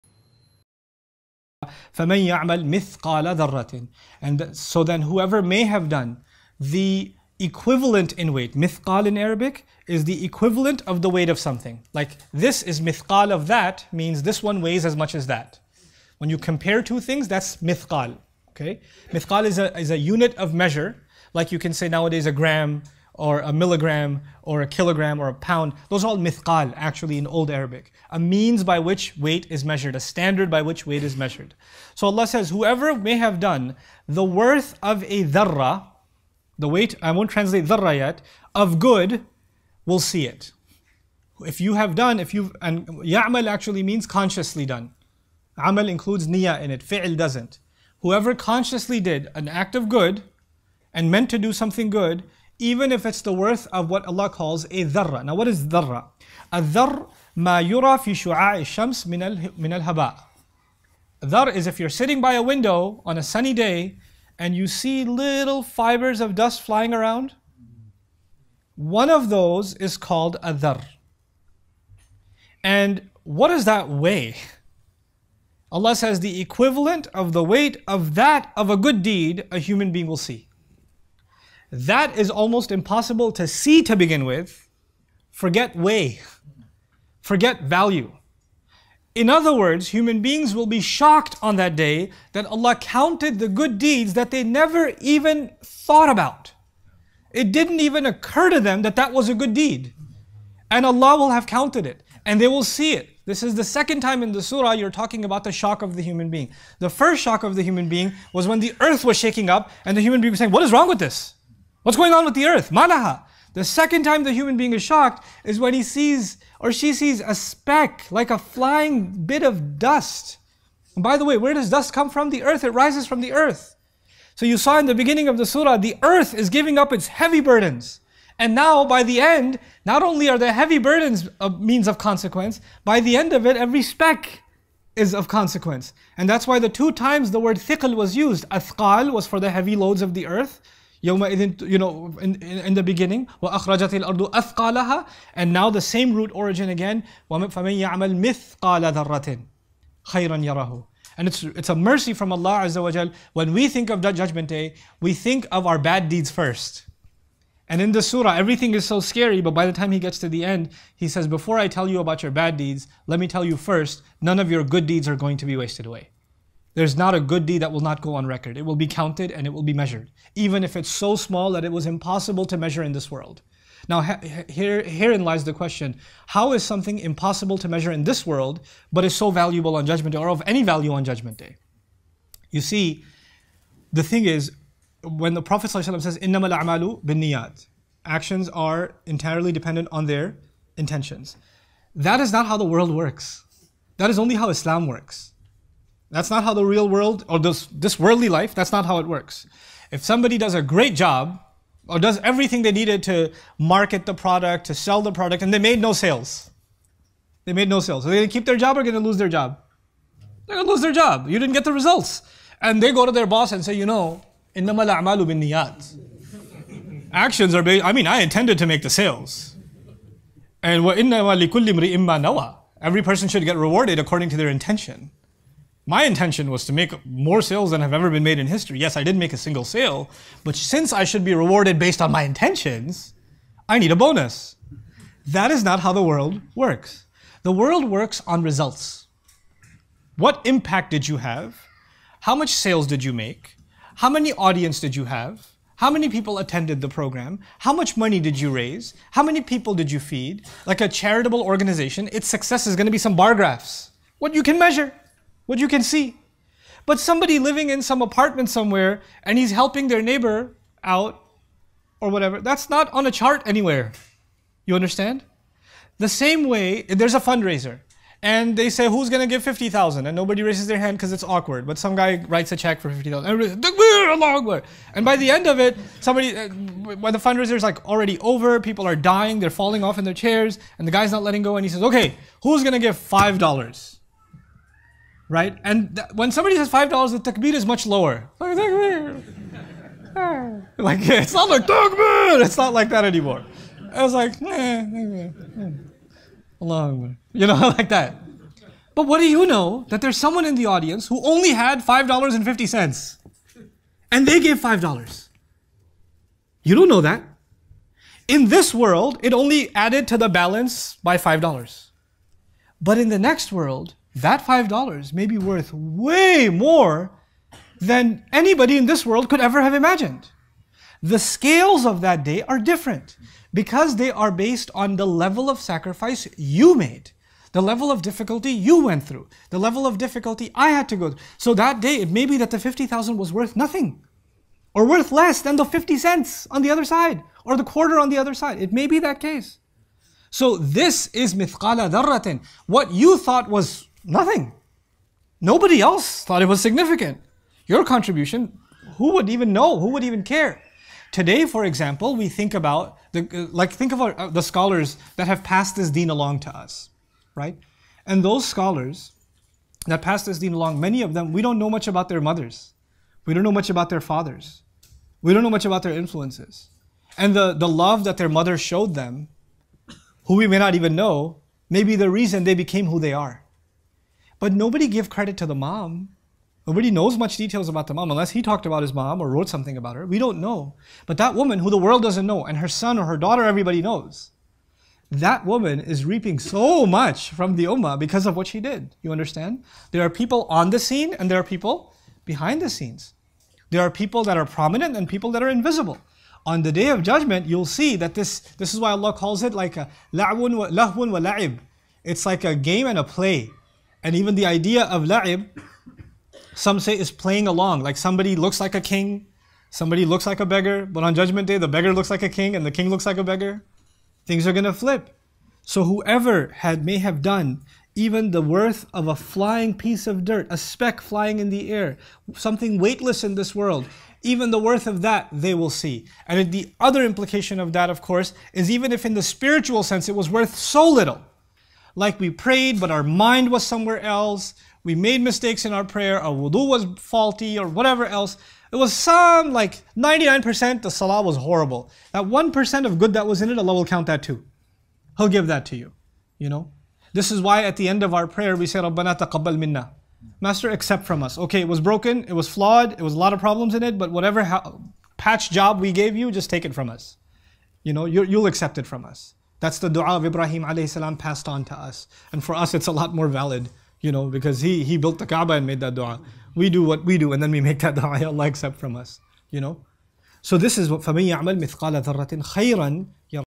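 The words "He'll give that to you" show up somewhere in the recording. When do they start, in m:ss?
7:25.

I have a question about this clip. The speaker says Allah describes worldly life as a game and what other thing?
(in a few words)
A play.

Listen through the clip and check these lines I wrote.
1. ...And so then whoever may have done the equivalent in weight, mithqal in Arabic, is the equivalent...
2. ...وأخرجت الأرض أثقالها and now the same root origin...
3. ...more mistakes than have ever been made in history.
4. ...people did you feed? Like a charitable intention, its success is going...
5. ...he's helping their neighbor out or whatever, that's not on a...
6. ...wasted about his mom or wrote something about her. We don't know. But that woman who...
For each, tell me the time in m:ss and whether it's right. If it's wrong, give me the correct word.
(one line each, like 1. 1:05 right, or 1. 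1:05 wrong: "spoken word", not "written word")
1. 0:04 right
2. 2:23 right
3. 3:47 wrong: "sales", not "mistakes"
4. 4:09 wrong: "organization", not "intention"
5. 4:19 right
6. 6:18 wrong: "talked", not "wasted".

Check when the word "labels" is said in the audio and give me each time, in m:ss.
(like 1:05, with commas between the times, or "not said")
not said.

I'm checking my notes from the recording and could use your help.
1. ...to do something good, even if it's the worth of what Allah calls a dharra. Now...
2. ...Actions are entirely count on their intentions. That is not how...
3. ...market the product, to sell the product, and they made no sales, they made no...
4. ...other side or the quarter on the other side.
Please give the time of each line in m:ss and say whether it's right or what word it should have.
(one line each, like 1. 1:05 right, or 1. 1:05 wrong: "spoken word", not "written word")
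1. 0:51 right
2. 3:08 wrong: "dependent", not "count"
3. 3:23 right
4. 5:36 right.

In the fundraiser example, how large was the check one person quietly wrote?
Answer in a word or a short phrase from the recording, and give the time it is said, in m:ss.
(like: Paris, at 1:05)
50,000, at 4:32.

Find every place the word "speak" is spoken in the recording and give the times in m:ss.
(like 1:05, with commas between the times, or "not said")
not said.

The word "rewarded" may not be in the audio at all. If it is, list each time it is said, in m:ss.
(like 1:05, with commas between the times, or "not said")
3:43, 3:51.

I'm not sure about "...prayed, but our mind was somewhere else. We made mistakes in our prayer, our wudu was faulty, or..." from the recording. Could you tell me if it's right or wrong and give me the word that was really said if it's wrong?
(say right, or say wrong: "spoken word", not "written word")
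right.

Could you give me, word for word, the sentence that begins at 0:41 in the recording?
If you have done, if you've, and ya'mal actually means consciously done.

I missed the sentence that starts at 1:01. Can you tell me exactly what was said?
Dhar is if you're sitting by a window on a sunny day and you see little fibers of dust flying around.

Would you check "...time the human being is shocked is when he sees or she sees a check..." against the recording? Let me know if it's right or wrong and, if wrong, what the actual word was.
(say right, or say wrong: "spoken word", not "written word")
wrong: "speck", not "check".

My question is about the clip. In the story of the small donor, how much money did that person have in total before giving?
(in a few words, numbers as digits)
$5.50.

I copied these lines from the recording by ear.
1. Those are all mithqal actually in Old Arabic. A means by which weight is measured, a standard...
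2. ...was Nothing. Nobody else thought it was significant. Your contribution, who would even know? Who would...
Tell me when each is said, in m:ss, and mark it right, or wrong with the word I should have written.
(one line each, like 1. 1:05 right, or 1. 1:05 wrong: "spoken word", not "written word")
1. 0:25 right
2. 5:43 right.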